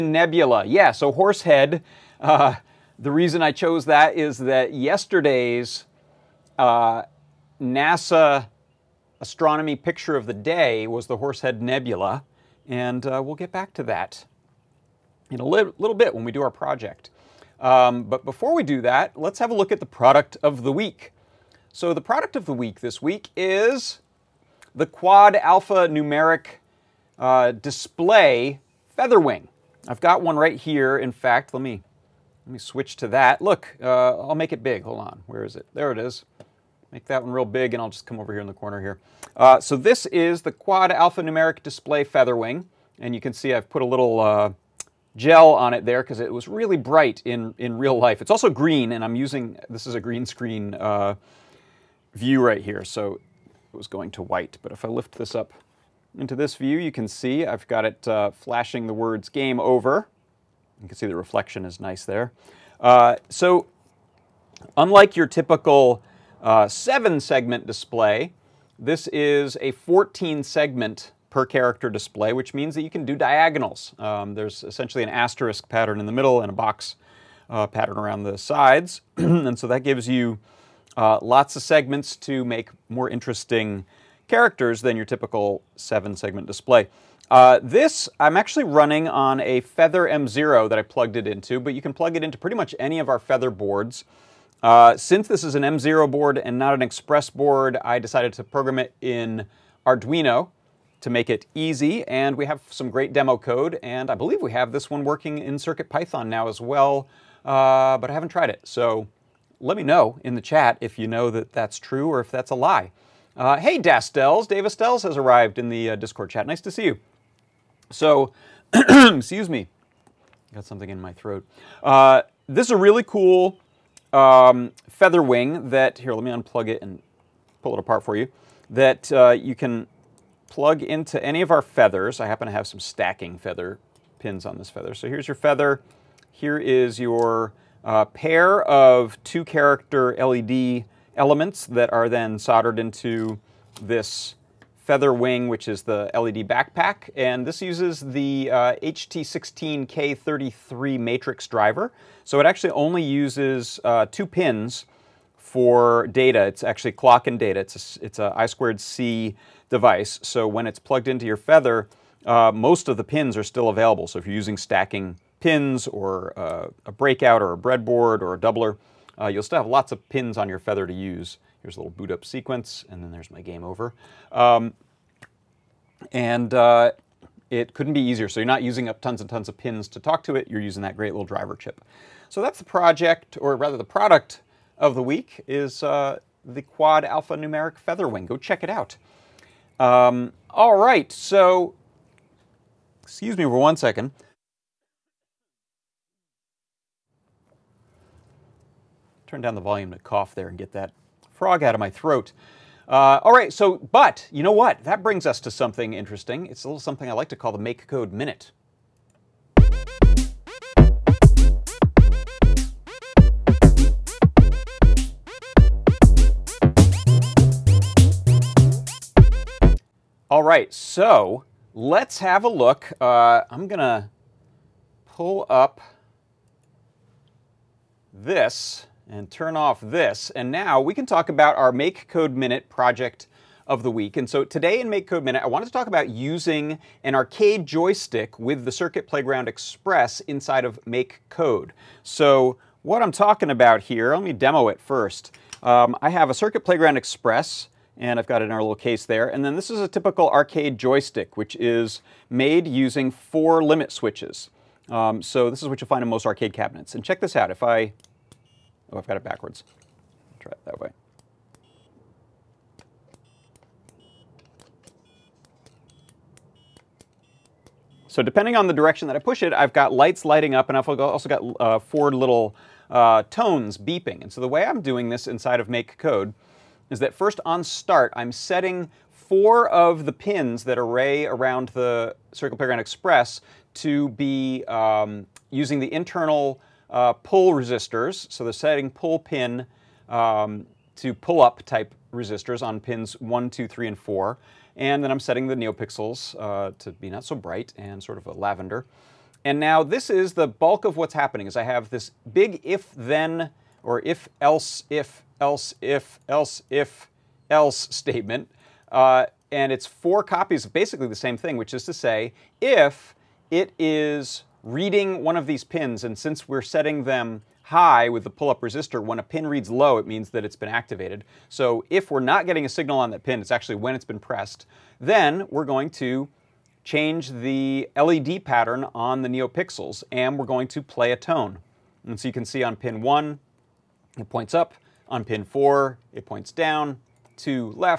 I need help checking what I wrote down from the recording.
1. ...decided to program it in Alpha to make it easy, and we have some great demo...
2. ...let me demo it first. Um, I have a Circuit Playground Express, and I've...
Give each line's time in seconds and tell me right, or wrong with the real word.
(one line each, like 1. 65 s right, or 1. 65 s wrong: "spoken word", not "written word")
1. 97 s wrong: "Arduino", not "Alpha"
2. 244 s right.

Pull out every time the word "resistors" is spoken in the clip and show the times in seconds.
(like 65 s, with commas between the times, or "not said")
287 s, 292 s, 318 s.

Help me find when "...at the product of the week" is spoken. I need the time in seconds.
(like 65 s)
19 s.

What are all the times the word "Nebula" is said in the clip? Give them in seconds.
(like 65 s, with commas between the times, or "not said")
0 s, 11 s.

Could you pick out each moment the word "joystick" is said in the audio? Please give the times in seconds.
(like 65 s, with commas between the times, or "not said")
237 s, 250 s.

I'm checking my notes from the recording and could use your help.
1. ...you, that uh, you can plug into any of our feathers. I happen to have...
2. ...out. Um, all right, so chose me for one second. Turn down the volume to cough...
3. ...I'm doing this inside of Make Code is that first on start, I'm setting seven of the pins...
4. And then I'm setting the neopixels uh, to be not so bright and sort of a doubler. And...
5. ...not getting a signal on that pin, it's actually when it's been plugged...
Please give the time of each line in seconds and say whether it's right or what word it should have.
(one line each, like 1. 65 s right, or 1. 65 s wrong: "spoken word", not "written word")
1. 128 s right
2. 188 s wrong: "excuse", not "chose"
3. 274 s wrong: "four", not "seven"
4. 294 s wrong: "lavender", not "doubler"
5. 322 s wrong: "pressed", not "plugged".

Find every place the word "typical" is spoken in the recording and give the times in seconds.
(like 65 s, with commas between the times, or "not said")
65 s, 85 s, 249 s.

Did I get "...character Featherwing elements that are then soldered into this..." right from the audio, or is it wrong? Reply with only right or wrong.
wrong.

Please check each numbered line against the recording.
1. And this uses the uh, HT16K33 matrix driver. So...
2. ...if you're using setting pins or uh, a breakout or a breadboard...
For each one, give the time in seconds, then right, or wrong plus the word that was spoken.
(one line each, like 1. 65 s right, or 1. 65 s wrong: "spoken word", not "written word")
1. 147 s right
2. 164 s wrong: "stacking", not "setting".